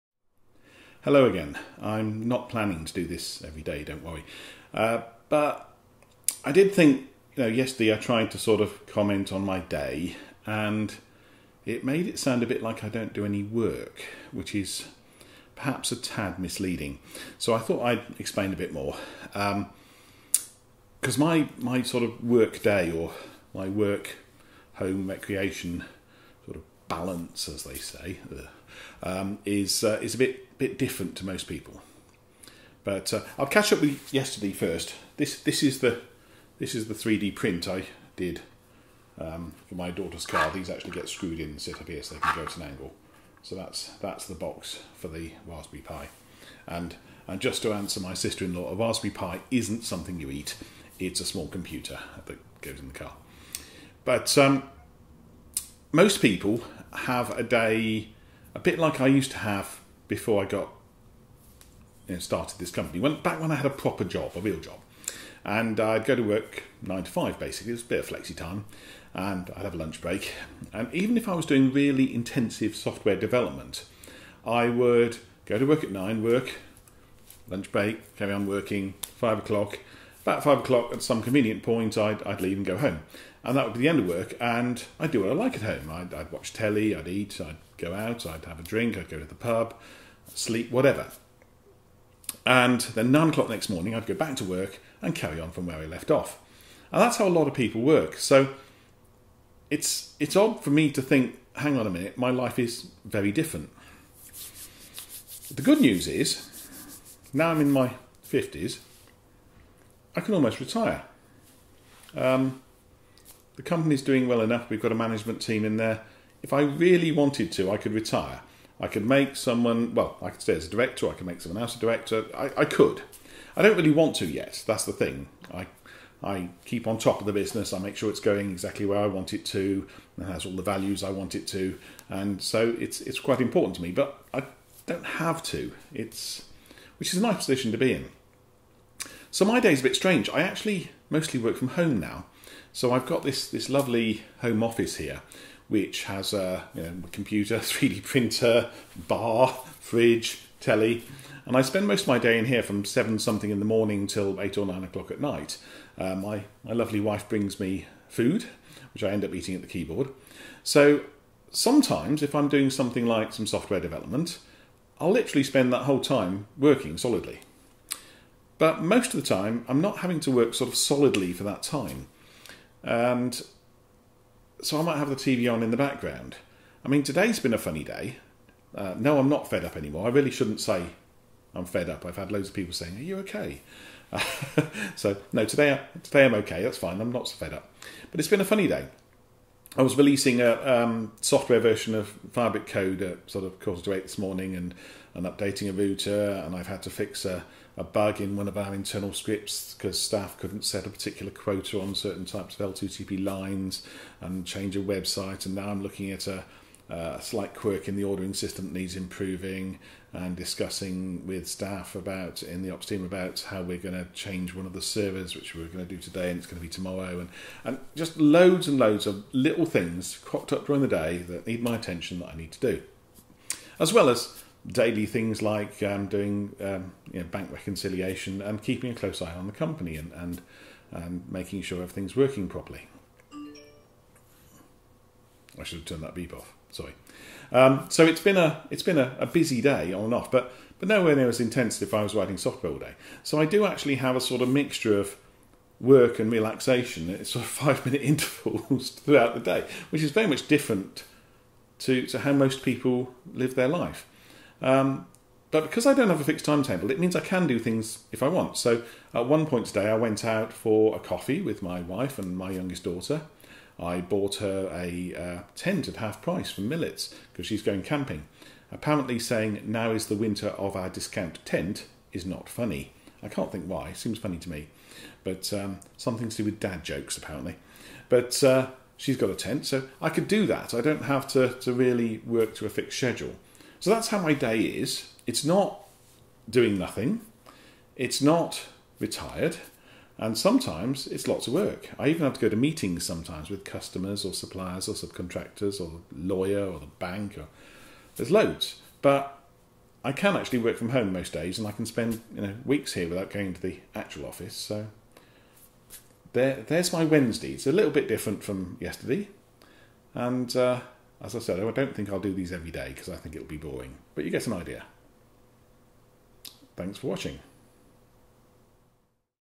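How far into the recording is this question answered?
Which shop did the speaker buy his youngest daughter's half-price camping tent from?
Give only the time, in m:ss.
4:26.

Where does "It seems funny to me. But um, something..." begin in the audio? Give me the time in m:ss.
4:33.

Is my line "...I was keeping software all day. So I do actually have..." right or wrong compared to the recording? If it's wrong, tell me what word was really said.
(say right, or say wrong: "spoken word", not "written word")
wrong: "writing", not "keeping".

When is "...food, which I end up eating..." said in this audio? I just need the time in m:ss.
2:38.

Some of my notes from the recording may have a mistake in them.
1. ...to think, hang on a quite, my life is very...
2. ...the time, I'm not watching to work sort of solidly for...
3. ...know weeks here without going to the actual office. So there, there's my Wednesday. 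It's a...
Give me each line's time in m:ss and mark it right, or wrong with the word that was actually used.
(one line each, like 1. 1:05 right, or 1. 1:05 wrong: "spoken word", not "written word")
1. 1:40 wrong: "minute", not "quite"
2. 2:49 wrong: "having", not "watching"
3. 5:02 right.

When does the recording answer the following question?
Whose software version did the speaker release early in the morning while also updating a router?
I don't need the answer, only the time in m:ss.
3:12.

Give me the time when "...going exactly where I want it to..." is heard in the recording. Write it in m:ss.
2:08.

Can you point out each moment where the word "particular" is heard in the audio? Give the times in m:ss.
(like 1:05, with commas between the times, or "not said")
3:20.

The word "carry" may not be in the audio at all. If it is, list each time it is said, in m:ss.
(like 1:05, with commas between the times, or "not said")
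1:18, 1:35.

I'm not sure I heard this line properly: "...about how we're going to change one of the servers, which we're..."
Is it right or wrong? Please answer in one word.
right.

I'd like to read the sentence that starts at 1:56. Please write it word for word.
If I really wanted to, I could retire.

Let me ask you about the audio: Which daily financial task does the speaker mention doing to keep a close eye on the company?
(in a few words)
bank reconciliation.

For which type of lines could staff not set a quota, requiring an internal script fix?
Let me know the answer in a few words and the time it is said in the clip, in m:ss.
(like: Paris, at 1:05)
L2TP, at 3:22.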